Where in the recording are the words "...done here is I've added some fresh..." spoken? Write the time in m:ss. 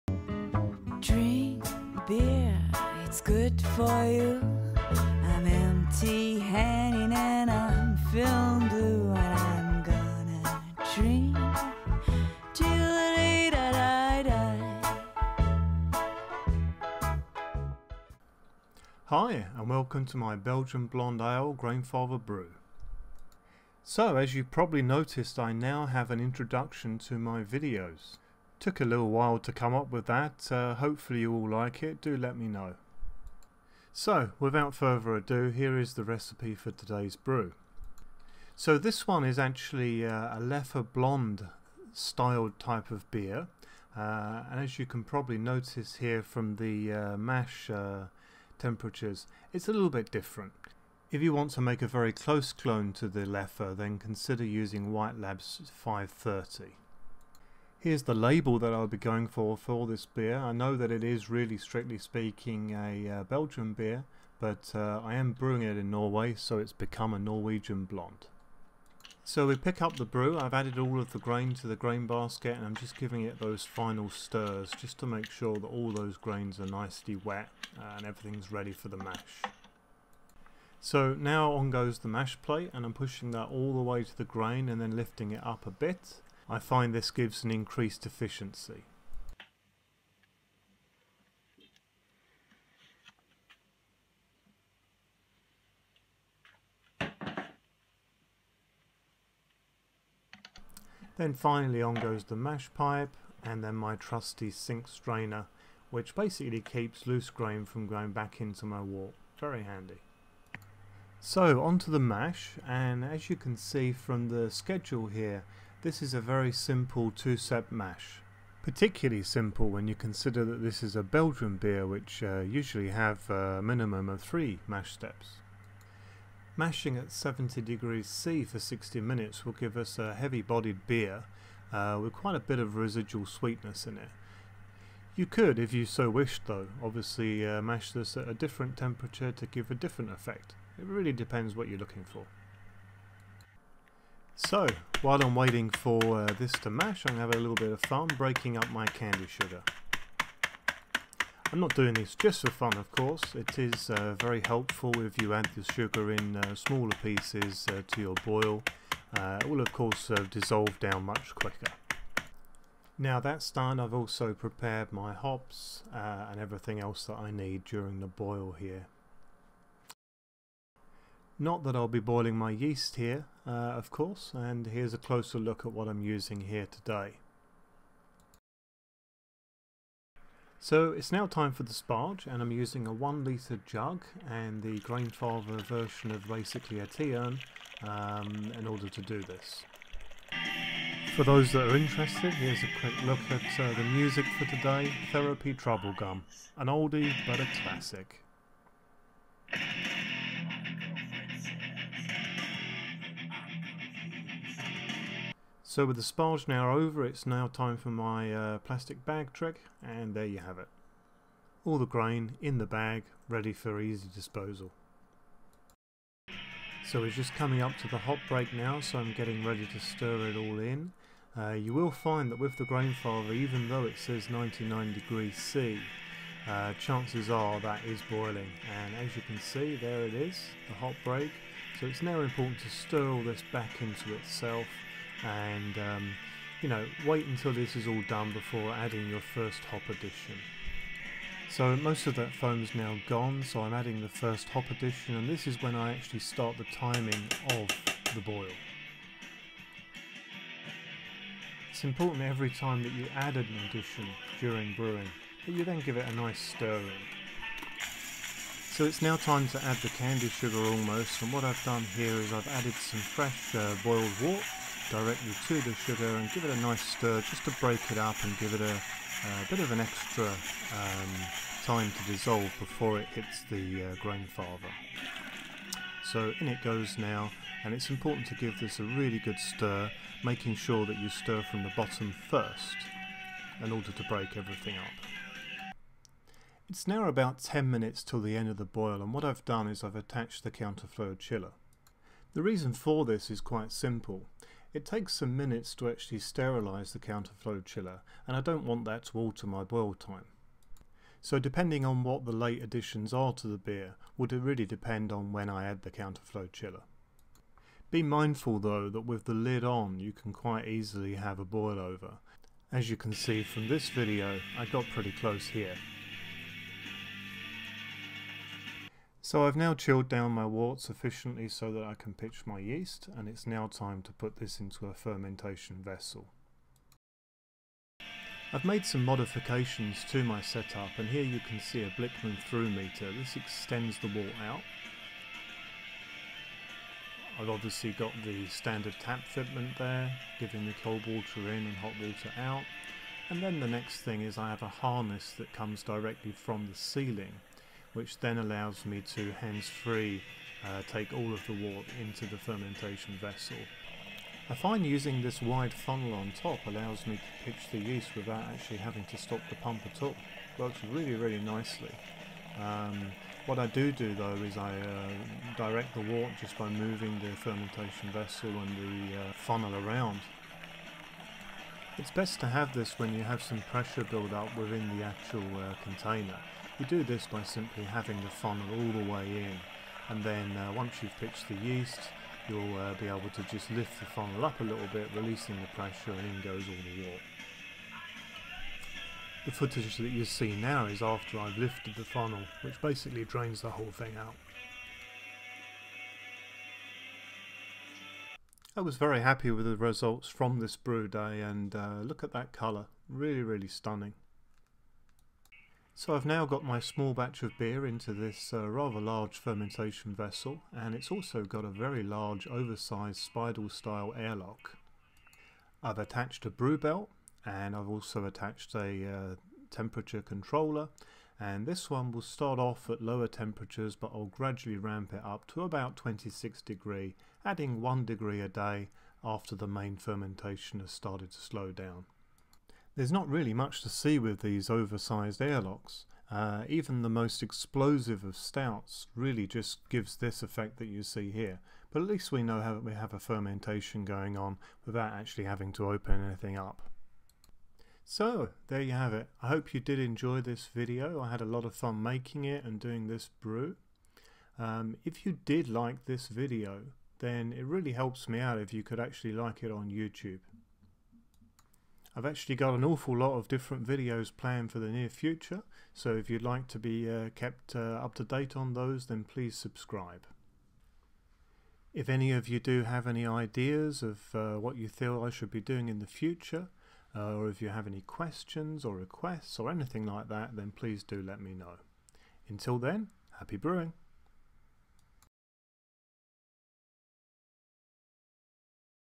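4:21.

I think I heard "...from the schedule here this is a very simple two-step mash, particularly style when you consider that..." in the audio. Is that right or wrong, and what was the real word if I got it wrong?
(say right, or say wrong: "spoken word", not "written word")
wrong: "simple", not "style".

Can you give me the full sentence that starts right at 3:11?
For those that are interested, here's a quick look at uh, the music for today, Therapy Troublegum, an oldie but a classic.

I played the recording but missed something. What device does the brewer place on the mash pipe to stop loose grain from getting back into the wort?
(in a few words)
sink strainer.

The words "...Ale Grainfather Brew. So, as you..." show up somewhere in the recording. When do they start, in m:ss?
0:21.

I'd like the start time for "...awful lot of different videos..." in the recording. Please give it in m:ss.
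7:42.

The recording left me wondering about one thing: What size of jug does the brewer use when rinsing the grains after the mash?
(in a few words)
1 litre.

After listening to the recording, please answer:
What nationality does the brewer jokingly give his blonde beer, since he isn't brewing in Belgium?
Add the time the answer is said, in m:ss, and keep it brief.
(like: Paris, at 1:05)
Norwegian, at 1:07.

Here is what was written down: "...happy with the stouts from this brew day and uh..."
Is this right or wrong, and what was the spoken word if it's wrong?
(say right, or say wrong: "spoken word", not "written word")
wrong: "results", not "stouts".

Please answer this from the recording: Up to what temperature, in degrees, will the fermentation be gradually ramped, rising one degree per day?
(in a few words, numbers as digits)
26.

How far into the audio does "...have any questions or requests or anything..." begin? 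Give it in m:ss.
7:57.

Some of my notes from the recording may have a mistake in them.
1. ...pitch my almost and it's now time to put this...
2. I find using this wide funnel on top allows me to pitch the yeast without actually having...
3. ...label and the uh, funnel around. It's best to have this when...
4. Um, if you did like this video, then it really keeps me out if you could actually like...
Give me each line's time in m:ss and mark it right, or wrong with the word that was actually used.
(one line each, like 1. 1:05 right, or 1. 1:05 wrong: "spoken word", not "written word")
1. 5:22 wrong: "yeast", not "almost"
2. 5:54 right
3. 6:08 wrong: "vessel", not "label"
4. 7:34 wrong: "helps", not "keeps".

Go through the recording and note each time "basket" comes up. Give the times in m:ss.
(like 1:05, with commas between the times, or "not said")
1:12.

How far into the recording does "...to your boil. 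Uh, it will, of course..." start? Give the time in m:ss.
2:37.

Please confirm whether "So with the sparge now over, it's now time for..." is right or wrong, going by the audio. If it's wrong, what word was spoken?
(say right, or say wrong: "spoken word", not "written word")
right.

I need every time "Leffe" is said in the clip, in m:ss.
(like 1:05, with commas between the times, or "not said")
0:40, 0:53.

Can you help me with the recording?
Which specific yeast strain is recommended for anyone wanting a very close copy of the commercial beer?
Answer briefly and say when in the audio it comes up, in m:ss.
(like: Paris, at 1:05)
White Labs 530, at 0:54.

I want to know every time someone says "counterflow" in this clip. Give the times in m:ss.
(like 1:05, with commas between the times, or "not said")
4:50, 4:56, 5:05.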